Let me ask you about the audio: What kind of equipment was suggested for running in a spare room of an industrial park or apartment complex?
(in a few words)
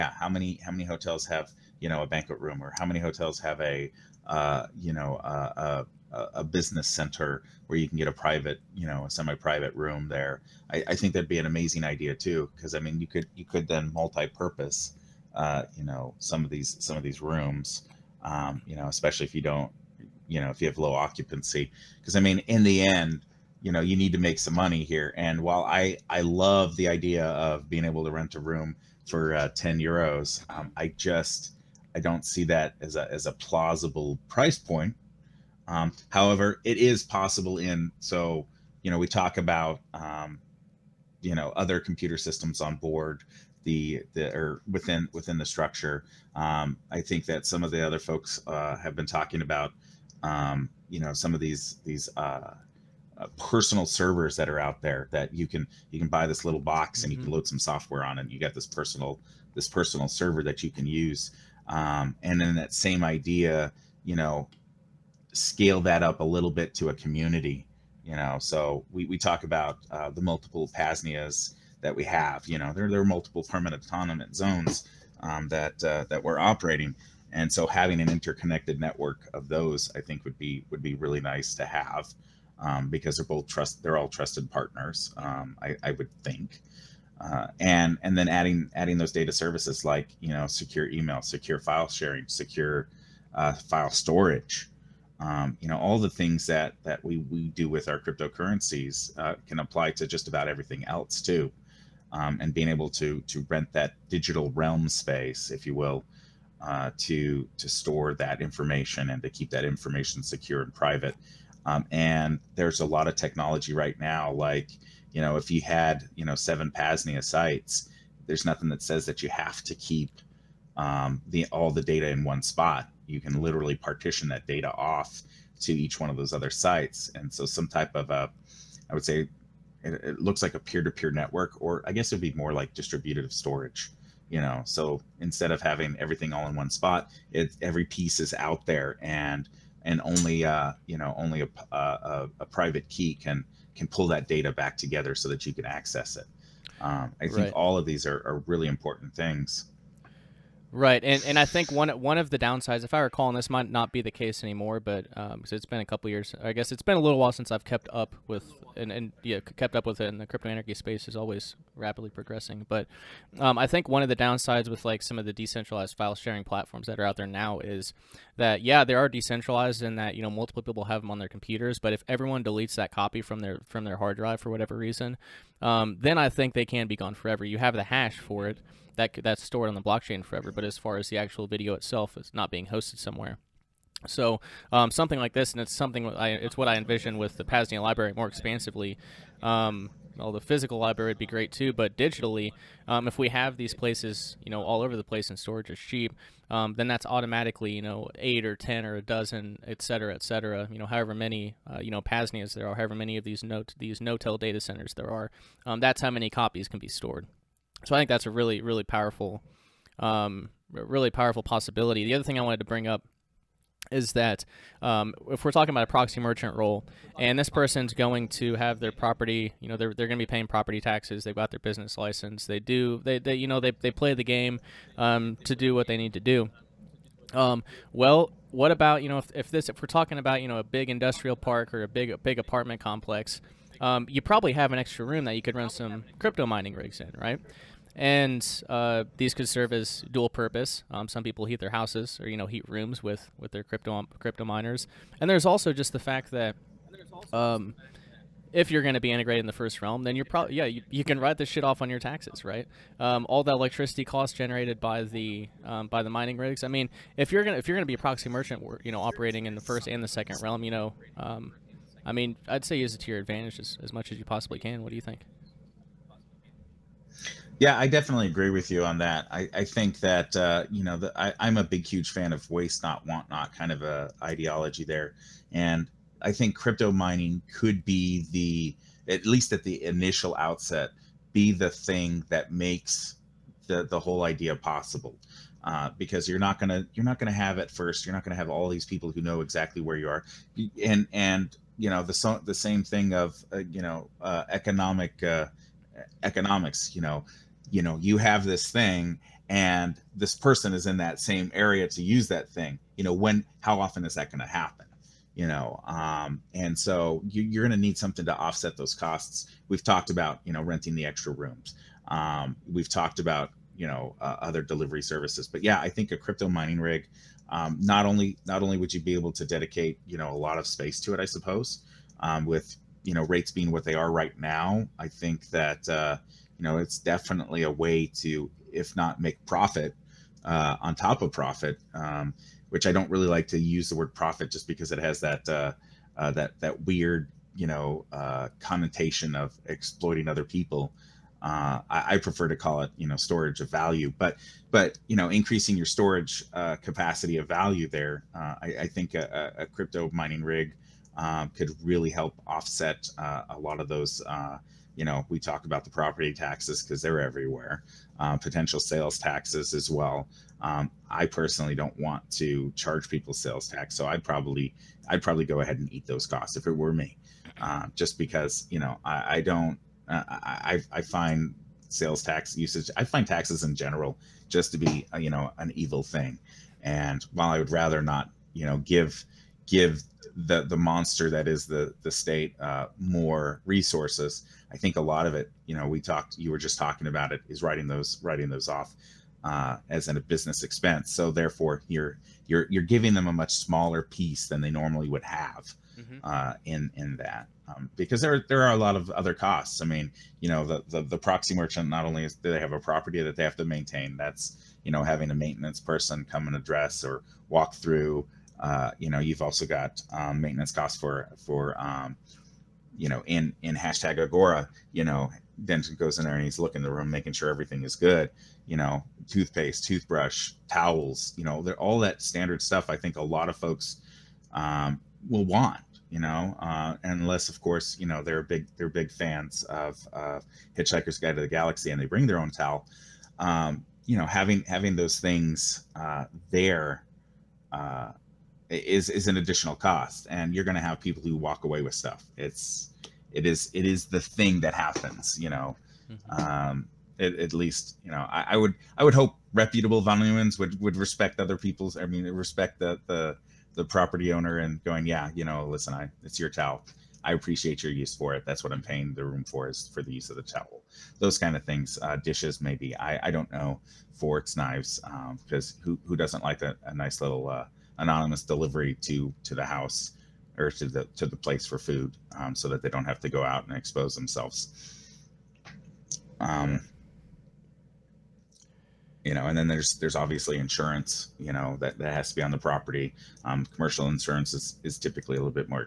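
Crypto mining rigs.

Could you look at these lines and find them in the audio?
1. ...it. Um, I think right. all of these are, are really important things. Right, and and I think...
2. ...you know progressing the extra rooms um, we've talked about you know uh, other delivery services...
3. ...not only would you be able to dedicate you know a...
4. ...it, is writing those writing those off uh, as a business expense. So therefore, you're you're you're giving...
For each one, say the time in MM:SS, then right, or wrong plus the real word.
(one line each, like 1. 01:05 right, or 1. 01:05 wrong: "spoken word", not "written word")
1. 02:26 right
2. 05:10 wrong: "renting", not "progressing"
3. 05:18 right
4. 06:27 right.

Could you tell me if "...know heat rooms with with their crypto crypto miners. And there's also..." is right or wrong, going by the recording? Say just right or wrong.
right.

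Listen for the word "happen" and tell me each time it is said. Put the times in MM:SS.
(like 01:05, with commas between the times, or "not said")
05:04, 07:24.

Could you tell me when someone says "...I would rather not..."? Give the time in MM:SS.
06:17.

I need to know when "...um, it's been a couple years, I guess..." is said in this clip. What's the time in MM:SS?
02:35.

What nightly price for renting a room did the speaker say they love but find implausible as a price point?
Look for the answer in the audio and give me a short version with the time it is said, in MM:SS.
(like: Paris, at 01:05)
10 euros, at 00:29.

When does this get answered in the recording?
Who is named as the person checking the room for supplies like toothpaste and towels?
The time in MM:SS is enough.
06:55.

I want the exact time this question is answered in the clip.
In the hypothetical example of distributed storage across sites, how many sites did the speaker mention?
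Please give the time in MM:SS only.
01:56.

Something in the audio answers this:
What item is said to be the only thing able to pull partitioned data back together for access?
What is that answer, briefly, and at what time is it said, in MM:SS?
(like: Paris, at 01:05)
A private key, at 02:22.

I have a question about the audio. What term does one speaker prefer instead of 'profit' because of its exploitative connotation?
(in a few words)
Storage of value.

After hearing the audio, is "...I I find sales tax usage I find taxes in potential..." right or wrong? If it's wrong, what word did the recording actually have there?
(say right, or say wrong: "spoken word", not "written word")
wrong: "general", not "potential".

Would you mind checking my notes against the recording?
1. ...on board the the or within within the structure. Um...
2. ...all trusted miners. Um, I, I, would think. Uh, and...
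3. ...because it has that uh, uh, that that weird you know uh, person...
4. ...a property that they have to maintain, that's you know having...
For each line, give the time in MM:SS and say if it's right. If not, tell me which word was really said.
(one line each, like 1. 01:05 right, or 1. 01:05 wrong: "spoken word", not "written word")
1. 00:42 right
2. 01:23 wrong: "partners", not "miners"
3. 05:34 wrong: "connotation", not "person"
4. 06:42 right.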